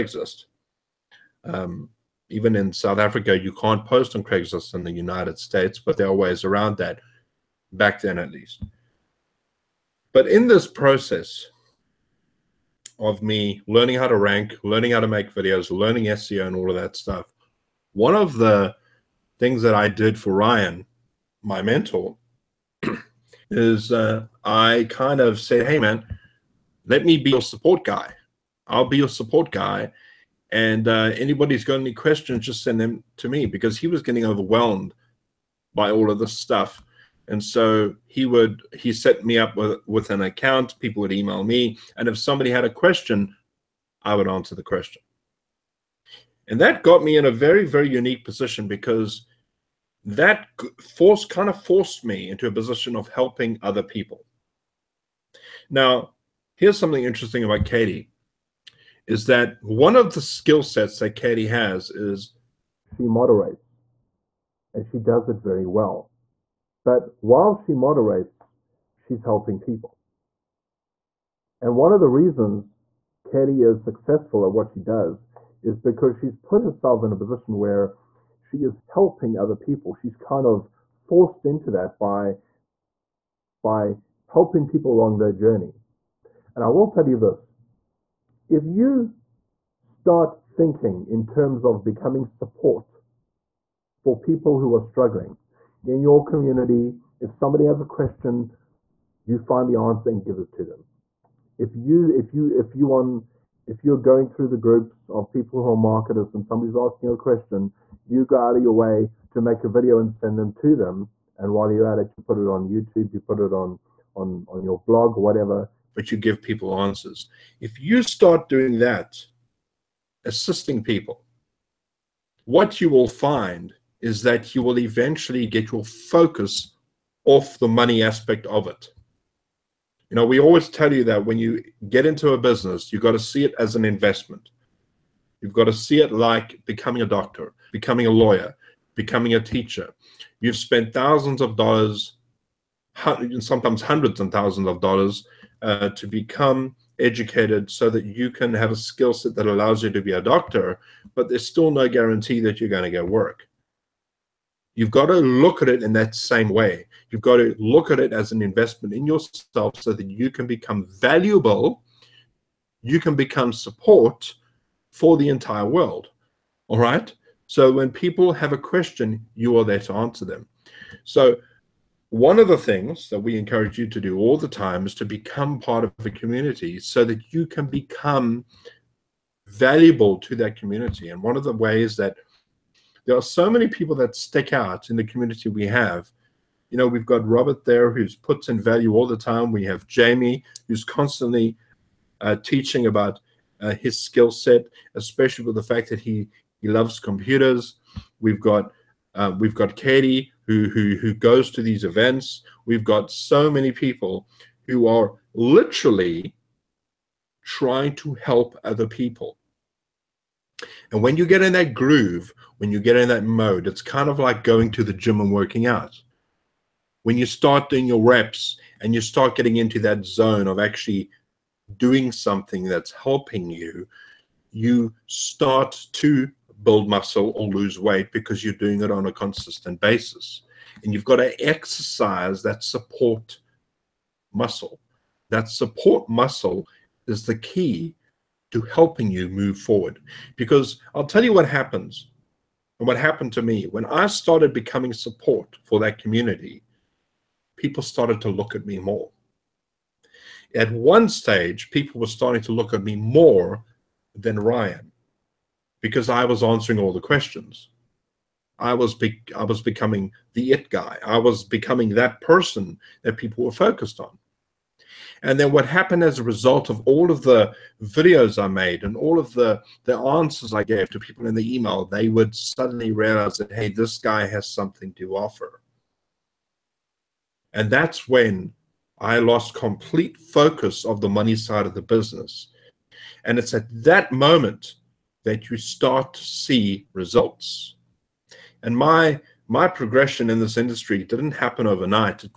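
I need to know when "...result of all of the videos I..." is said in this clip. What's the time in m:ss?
4:26.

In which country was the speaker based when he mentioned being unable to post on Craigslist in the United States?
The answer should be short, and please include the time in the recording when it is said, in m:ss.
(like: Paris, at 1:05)
South Africa, at 0:02.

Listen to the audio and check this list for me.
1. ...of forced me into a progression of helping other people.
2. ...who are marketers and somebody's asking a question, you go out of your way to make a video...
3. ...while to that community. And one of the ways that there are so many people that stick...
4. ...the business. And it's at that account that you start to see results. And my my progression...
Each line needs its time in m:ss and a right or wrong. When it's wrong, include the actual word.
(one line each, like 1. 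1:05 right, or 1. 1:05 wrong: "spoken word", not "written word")
1. 0:51 wrong: "position", not "progression"
2. 1:45 right
3. 2:59 wrong: "valuable", not "while"
4. 4:41 wrong: "moment", not "account".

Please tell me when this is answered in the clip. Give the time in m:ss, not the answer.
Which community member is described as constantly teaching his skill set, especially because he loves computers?
3:09.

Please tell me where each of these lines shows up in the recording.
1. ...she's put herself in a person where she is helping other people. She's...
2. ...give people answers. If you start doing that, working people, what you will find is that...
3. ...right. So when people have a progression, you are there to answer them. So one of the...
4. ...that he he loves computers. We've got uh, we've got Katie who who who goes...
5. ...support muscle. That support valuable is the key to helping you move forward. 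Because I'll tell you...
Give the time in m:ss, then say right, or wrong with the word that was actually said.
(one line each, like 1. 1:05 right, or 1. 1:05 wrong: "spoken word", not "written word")
1. 1:16 wrong: "position", not "person"
2. 1:56 wrong: "assisting", not "working"
3. 2:46 wrong: "question", not "progression"
4. 3:15 right
5. 3:52 wrong: "muscle", not "valuable".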